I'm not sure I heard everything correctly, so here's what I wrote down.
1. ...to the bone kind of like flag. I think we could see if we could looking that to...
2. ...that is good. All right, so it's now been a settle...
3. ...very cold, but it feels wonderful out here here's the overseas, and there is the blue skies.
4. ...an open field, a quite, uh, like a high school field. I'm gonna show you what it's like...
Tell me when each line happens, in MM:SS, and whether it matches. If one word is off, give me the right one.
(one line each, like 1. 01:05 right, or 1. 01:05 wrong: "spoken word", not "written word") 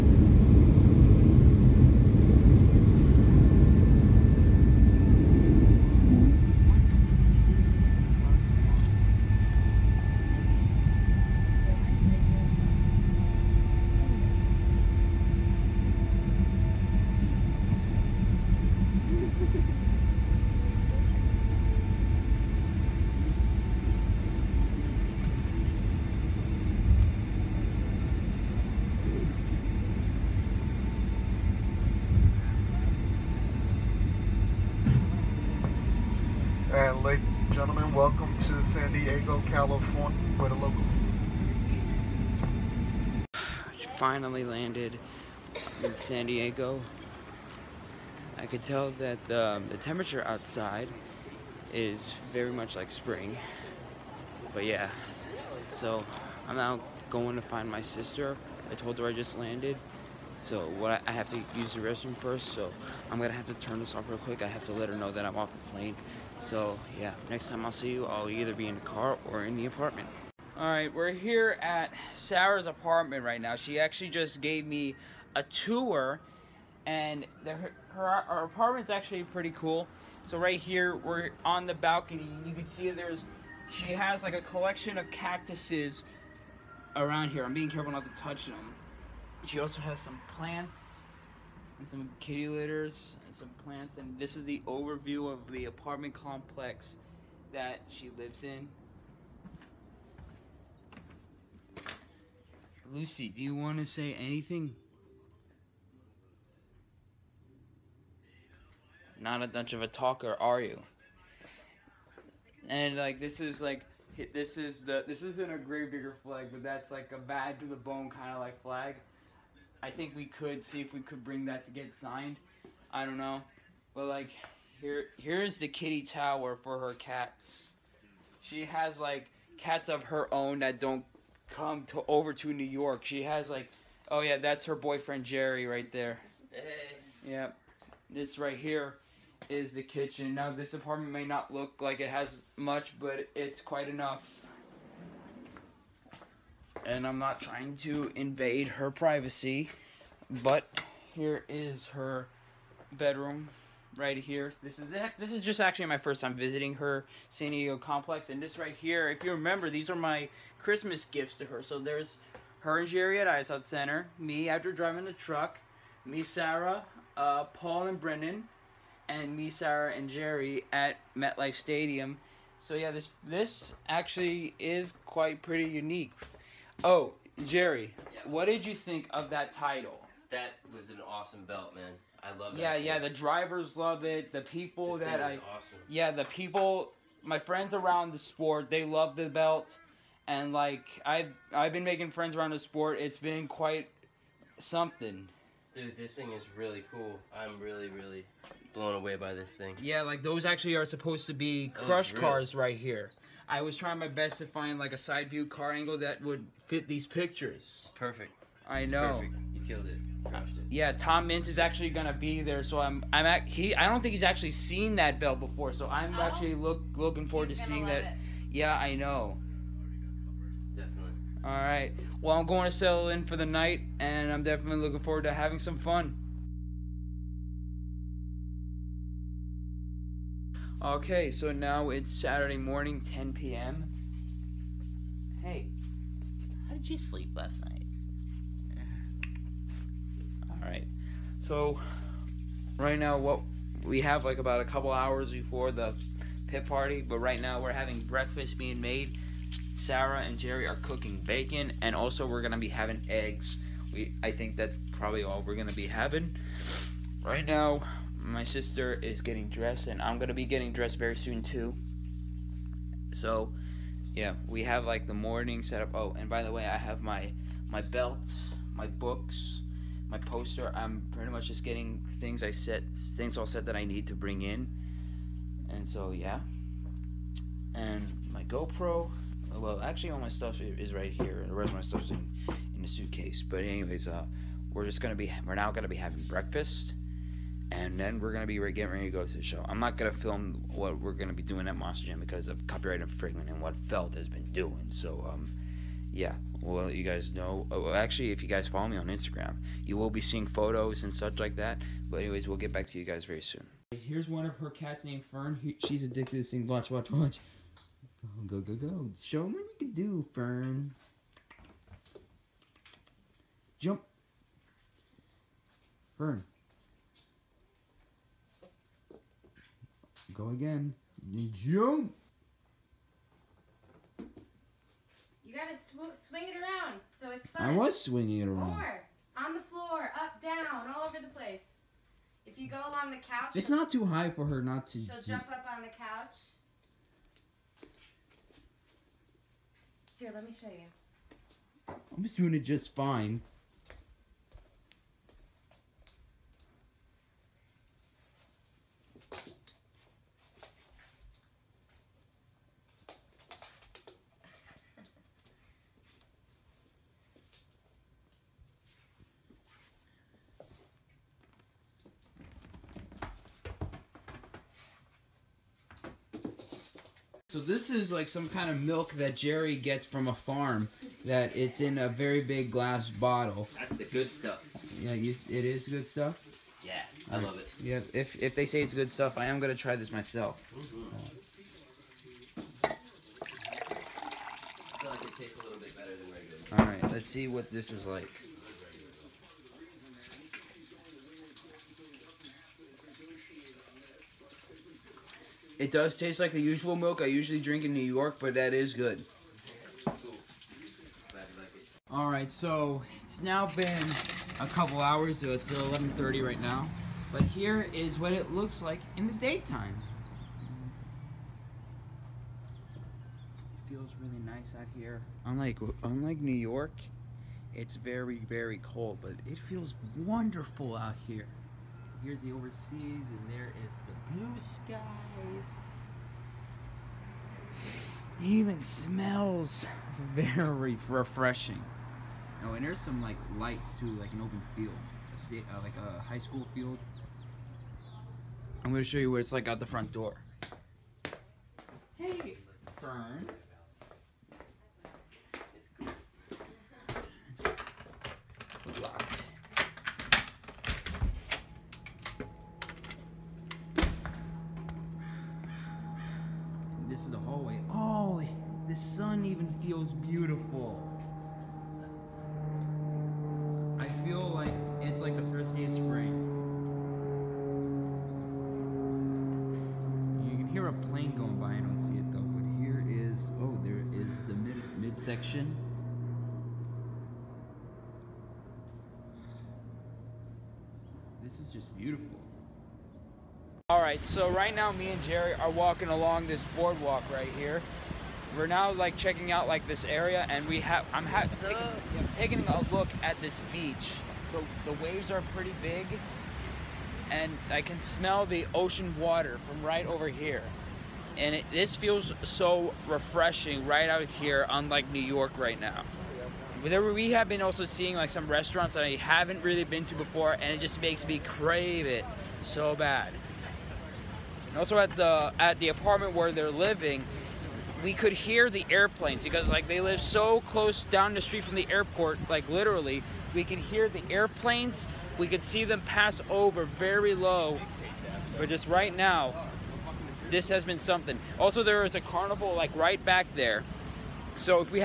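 1. 01:57 wrong: "bring", not "looking"
2. 06:38 wrong: "couple", not "settle"
3. 06:58 right
4. 07:14 wrong: "state", not "quite".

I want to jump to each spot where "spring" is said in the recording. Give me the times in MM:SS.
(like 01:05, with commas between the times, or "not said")
00:52, 07:45.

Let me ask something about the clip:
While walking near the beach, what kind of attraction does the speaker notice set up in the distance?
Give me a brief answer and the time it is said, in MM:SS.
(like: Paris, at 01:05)
carnival, at 08:52.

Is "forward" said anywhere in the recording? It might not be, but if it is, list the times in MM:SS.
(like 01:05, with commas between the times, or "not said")
03:37, 03:45.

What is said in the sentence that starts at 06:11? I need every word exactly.
That it's in a very big glass bottle.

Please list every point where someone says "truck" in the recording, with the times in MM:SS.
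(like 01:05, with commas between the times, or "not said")
02:45.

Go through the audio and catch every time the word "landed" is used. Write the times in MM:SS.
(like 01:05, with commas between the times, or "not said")
00:44, 00:59.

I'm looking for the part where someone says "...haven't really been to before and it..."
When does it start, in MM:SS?
08:29.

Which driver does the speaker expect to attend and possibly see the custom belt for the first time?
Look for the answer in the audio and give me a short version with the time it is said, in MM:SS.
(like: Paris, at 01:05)
Tom Meents, at 03:30.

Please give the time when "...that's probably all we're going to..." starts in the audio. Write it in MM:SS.
04:14.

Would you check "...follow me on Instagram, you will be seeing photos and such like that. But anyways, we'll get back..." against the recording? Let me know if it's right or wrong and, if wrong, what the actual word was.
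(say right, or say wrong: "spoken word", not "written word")
right.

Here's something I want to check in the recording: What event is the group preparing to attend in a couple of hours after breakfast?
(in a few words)
pit party.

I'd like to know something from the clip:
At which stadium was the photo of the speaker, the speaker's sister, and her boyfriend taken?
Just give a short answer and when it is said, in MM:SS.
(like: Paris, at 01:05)
MetLife Stadium, at 02:51.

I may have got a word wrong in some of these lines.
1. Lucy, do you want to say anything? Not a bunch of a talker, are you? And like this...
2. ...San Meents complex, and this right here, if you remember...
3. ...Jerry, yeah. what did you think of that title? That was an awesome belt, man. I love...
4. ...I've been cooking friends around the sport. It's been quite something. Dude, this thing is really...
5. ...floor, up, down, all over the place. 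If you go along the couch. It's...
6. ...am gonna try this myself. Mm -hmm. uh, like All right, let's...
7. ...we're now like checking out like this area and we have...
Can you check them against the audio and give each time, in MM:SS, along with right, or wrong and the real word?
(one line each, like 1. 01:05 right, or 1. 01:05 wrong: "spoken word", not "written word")
1. 01:42 right
2. 02:37 wrong: "Diego", not "Meents"
3. 02:57 right
4. 03:11 wrong: "making", not "cooking"
5. 05:29 right
6. 06:19 right
7. 08:08 right.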